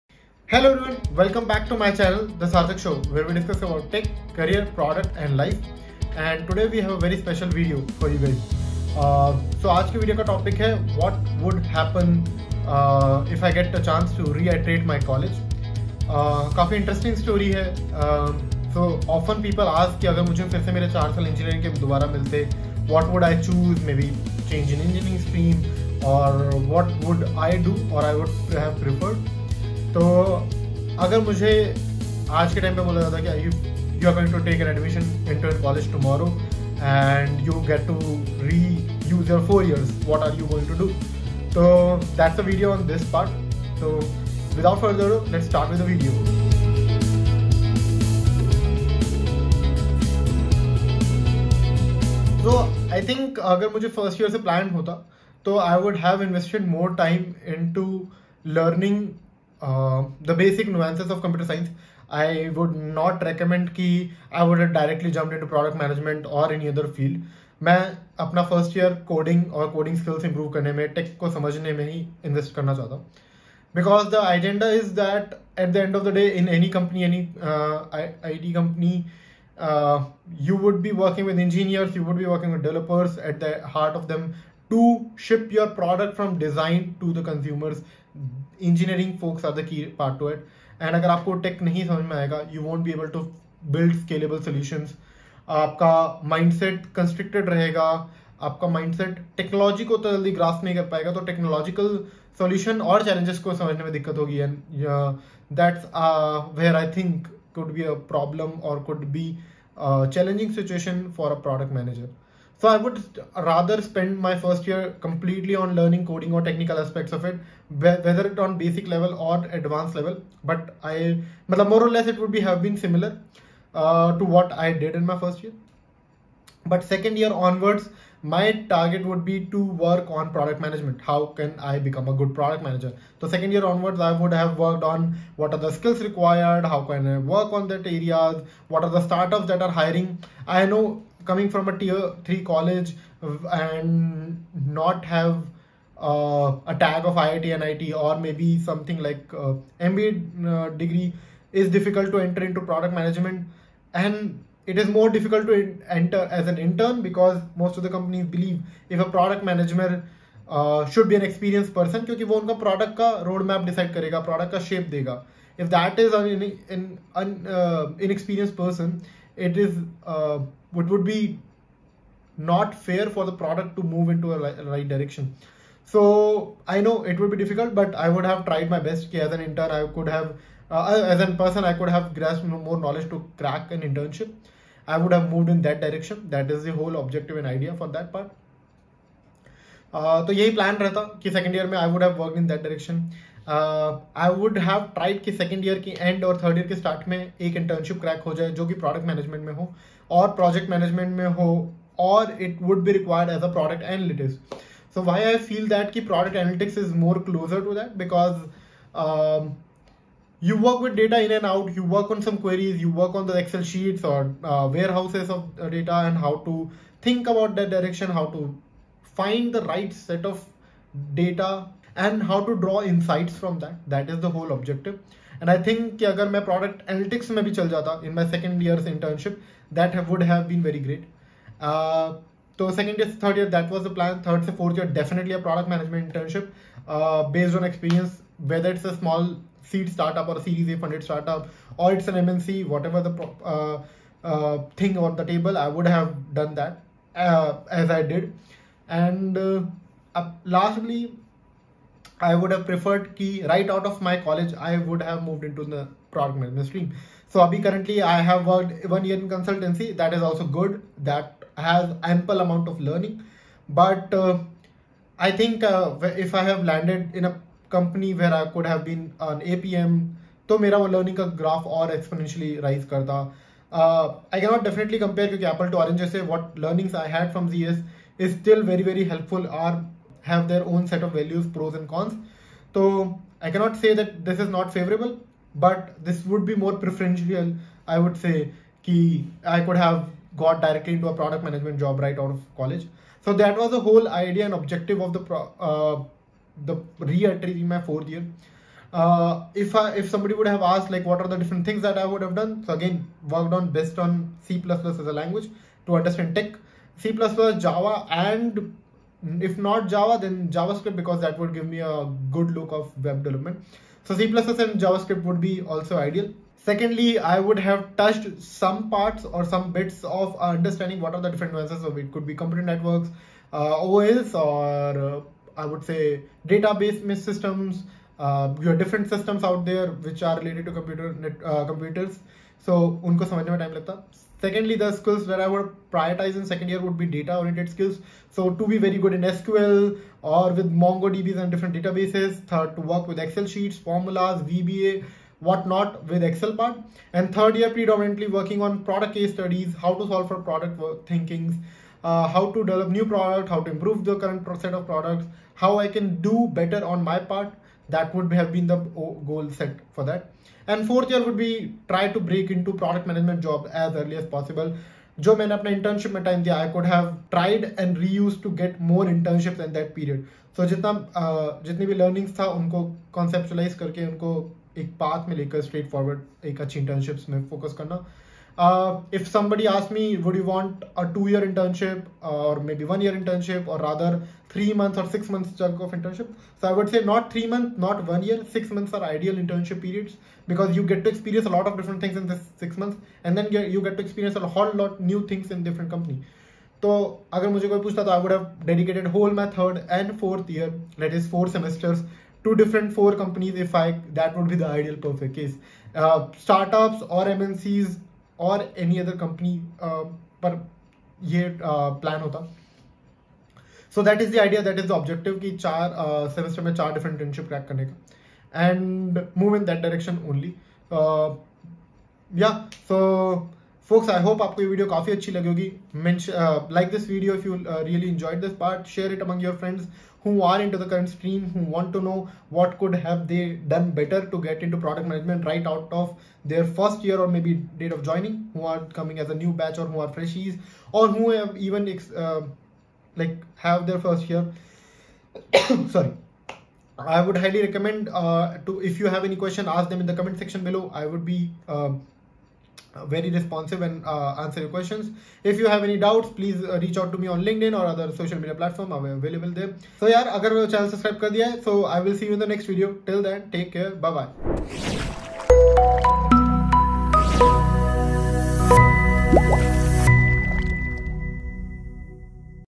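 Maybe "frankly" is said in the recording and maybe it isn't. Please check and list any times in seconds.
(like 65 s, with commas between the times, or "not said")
not said.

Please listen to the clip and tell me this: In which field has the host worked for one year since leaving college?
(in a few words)
consultancy.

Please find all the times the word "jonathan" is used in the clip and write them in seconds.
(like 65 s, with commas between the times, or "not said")
not said.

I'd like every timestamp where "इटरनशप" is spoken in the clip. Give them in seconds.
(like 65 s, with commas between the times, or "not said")
197 s, 417 s.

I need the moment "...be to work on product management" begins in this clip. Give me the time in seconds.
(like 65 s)
129 s.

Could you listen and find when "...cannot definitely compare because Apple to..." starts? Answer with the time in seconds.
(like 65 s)
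274 s.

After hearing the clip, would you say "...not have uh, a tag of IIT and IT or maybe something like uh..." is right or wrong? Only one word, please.
right.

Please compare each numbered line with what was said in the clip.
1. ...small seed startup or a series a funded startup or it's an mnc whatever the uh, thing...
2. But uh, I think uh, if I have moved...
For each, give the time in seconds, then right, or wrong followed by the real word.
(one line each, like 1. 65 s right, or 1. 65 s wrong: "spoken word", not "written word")
1. 238 s right
2. 263 s wrong: "landed", not "moved".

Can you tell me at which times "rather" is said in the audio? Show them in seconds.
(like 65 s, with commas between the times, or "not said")
113 s, 383 s.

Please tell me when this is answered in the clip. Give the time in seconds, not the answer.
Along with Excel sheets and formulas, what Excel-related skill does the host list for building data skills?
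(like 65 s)
344 s.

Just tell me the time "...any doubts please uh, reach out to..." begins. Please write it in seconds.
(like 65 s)
455 s.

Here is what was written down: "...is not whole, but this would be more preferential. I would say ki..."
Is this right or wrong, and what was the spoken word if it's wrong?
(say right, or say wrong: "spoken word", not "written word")
wrong: "favorable", not "whole".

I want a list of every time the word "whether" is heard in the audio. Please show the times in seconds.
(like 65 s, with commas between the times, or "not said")
117 s, 238 s.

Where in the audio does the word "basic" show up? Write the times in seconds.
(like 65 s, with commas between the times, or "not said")
60 s, 118 s.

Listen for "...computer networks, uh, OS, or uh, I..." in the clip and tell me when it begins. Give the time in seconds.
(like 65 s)
322 s.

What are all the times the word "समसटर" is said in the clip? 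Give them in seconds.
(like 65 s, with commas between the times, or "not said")
416 s.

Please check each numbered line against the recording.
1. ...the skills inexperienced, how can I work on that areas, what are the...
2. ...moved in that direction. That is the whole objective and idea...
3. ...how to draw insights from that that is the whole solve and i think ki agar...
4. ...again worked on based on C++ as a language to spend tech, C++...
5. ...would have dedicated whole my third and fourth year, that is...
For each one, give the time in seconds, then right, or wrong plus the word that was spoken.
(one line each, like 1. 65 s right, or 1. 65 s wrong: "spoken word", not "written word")
1. 135 s wrong: "required", not "inexperienced"
2. 185 s right
3. 222 s wrong: "objective", not "solve"
4. 302 s wrong: "understand", not "spend"
5. 398 s right.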